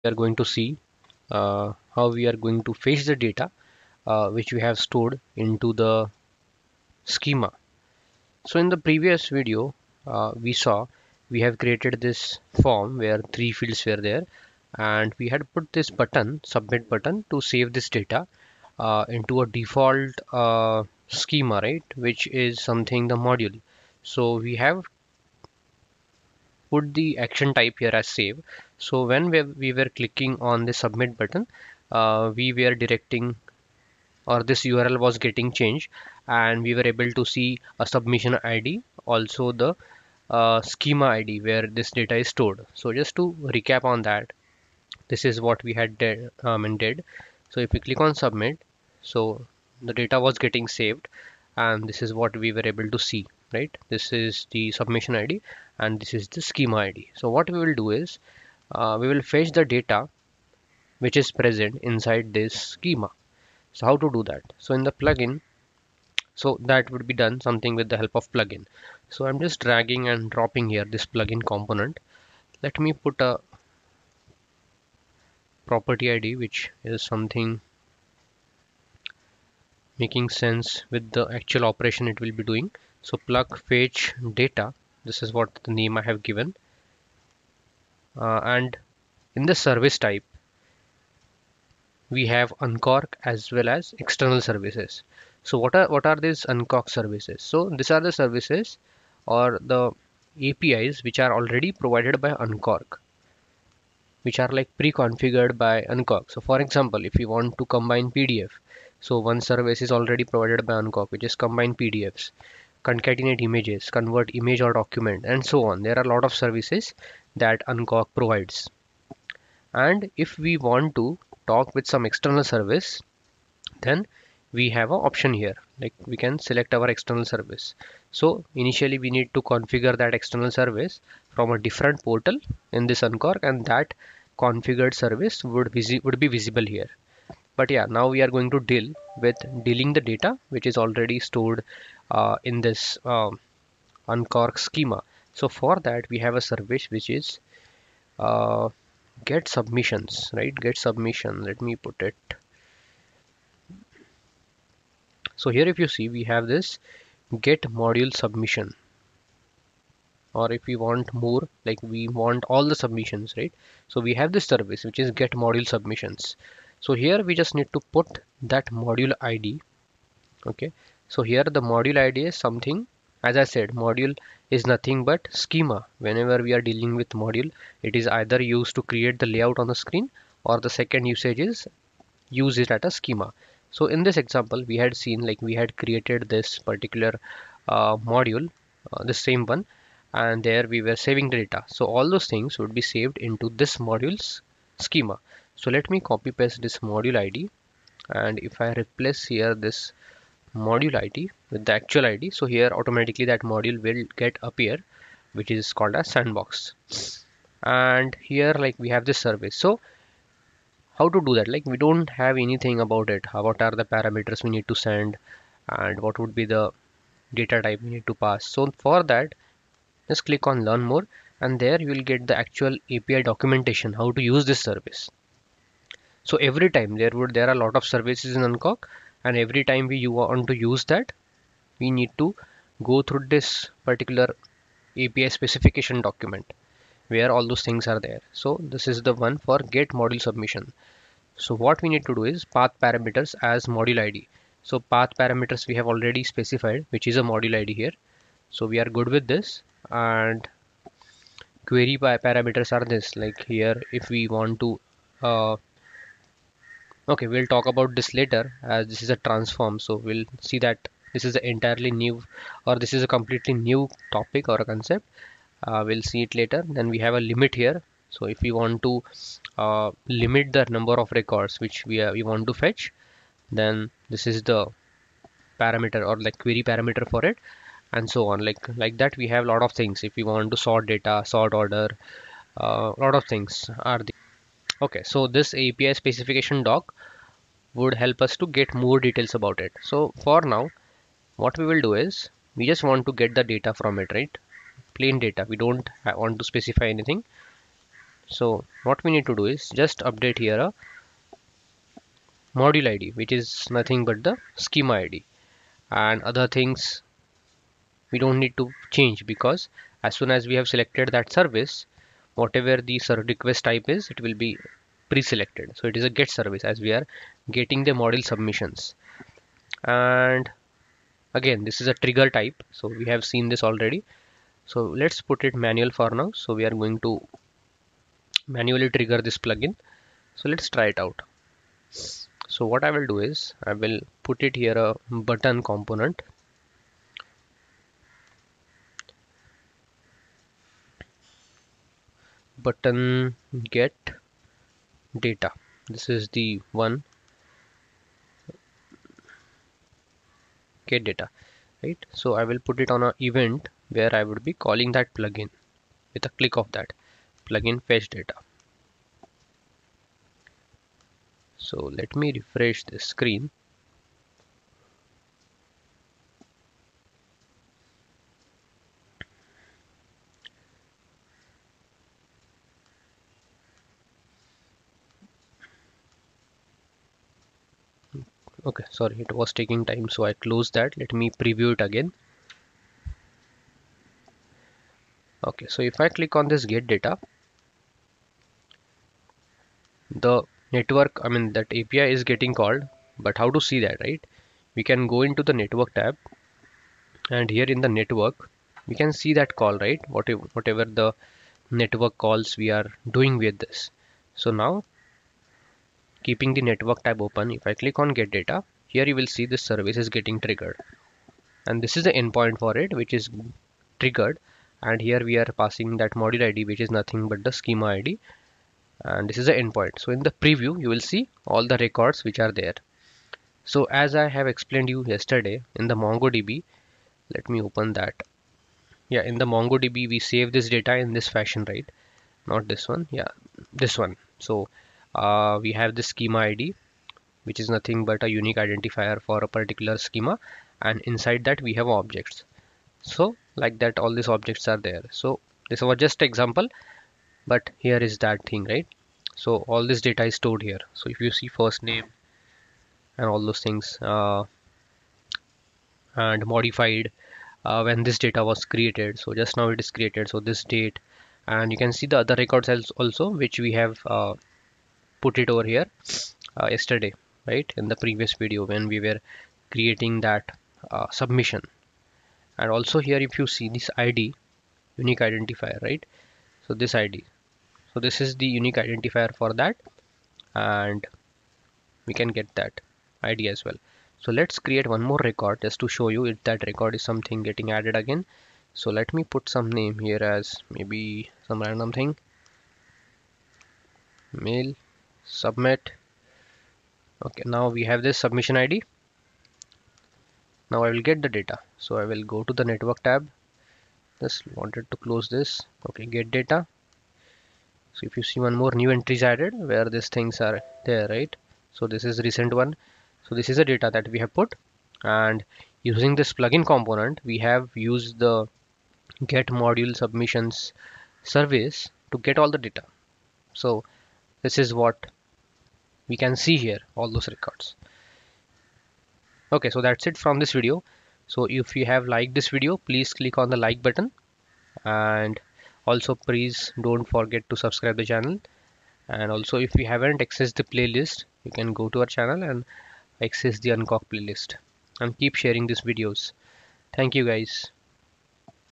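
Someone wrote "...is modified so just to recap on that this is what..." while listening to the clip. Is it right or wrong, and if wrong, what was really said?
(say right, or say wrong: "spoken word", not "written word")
wrong: "stored", not "modified".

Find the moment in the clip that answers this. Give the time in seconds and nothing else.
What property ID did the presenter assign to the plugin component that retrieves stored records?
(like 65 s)
83 s.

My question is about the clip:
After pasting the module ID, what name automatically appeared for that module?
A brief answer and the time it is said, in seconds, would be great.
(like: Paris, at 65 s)
sandbox, at 206 s.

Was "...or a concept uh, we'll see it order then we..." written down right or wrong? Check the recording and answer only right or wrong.
wrong.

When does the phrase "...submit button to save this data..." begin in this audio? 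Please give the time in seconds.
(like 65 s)
16 s.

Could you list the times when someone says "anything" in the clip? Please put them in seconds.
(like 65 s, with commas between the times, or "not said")
212 s, 296 s.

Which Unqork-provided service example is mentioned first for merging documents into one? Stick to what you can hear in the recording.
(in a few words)
combine pdfs.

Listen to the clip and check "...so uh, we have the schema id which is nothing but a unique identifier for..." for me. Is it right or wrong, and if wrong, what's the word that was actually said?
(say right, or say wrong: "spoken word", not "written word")
right.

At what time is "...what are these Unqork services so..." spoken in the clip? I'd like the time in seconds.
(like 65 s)
95 s.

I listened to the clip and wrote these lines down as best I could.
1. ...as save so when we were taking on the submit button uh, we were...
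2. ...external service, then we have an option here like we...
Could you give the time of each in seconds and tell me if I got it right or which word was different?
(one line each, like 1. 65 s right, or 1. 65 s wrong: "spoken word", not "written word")
1. 28 s wrong: "clicking", not "taking"
2. 122 s right.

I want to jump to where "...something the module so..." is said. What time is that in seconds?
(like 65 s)
22 s.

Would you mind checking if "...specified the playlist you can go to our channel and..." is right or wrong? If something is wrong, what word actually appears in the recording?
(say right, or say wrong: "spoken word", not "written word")
wrong: "accessed", not "specified".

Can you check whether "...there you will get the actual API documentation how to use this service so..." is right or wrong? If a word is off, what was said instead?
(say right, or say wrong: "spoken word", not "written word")
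right.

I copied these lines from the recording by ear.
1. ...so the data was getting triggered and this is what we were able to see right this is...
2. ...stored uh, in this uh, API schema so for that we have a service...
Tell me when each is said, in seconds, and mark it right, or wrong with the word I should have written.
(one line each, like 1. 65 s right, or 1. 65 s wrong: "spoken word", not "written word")
1. 49 s wrong: "saved", not "triggered"
2. 141 s wrong: "Unqork", not "API".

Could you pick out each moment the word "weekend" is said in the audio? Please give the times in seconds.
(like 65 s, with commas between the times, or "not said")
not said.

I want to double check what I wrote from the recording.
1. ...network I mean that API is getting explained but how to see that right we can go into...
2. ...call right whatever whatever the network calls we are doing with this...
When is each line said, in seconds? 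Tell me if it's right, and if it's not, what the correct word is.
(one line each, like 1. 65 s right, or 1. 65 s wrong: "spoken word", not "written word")
1. 390 s wrong: "called", not "explained"
2. 399 s right.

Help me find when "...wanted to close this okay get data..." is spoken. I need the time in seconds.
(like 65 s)
504 s.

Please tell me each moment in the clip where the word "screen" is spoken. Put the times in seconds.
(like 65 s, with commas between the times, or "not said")
179 s, 362 s.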